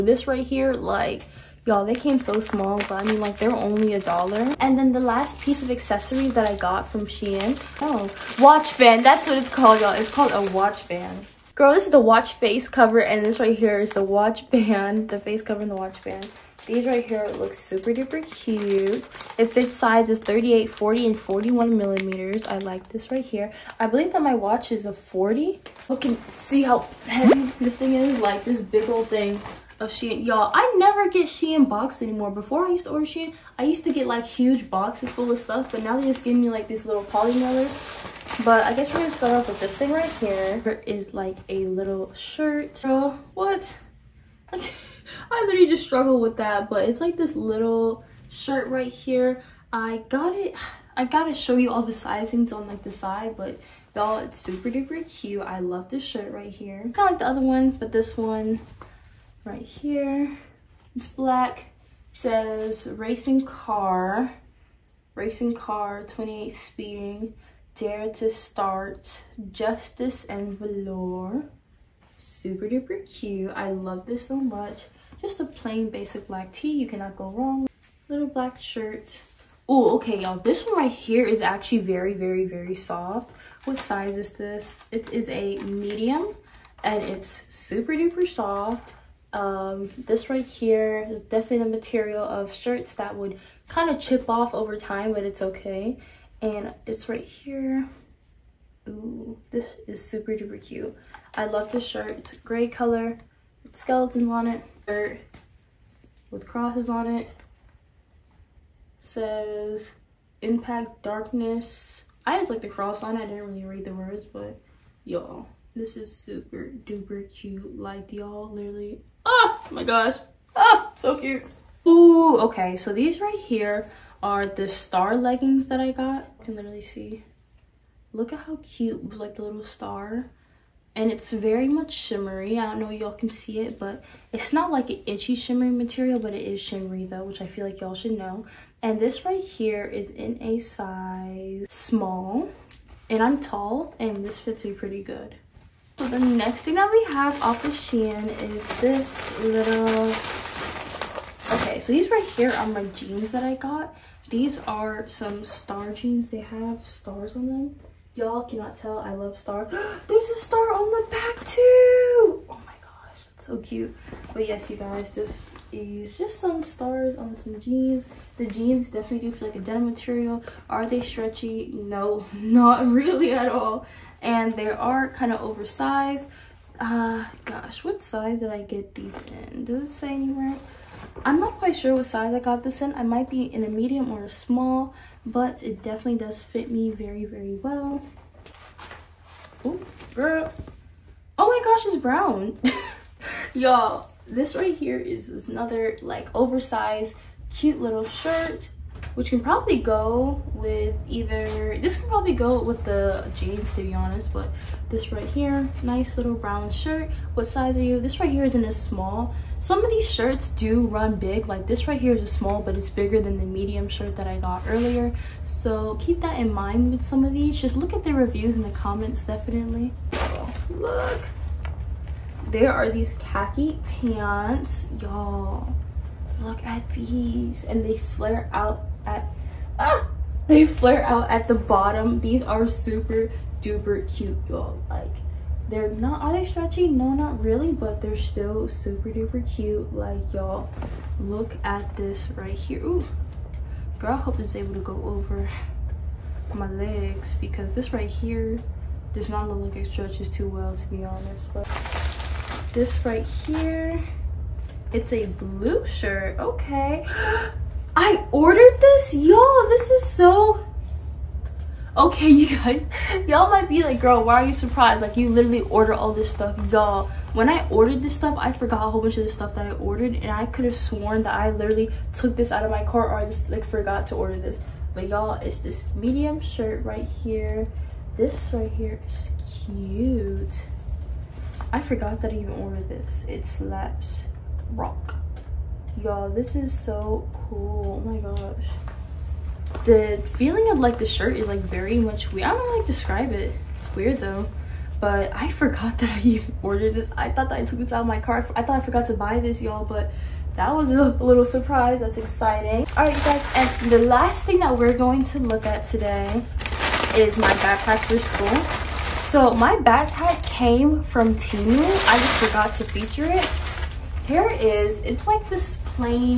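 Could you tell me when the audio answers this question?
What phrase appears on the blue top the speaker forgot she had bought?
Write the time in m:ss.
4:43.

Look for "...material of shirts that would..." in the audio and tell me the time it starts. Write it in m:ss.
1:31.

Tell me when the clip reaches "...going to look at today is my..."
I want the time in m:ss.
5:04.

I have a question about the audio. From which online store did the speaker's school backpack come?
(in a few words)
Temu.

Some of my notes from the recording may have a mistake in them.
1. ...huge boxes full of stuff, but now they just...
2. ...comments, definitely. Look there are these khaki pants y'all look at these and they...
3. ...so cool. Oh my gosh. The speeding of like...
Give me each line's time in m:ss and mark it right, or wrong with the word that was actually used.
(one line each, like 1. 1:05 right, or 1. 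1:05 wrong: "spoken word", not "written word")
1. 0:34 right
2. 3:38 right
3. 4:46 wrong: "feeling", not "speeding".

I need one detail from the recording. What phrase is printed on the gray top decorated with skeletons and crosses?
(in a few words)
Impact Darkness.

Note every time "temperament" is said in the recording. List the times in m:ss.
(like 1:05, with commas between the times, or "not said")
not said.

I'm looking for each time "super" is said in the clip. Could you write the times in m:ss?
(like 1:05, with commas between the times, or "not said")
0:17, 0:54, 1:12, 1:27, 1:40, 1:56, 3:52, 3:58.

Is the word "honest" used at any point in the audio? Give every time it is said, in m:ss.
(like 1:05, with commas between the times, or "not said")
3:23, 4:11.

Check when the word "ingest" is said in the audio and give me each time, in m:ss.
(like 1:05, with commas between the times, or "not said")
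not said.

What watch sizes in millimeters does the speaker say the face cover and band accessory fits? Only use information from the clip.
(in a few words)
38, 40, and 41.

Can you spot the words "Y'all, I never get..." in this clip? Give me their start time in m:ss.
0:30.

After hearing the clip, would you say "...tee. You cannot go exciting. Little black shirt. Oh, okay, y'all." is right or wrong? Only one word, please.
wrong.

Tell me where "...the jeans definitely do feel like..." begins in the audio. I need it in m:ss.
2:48.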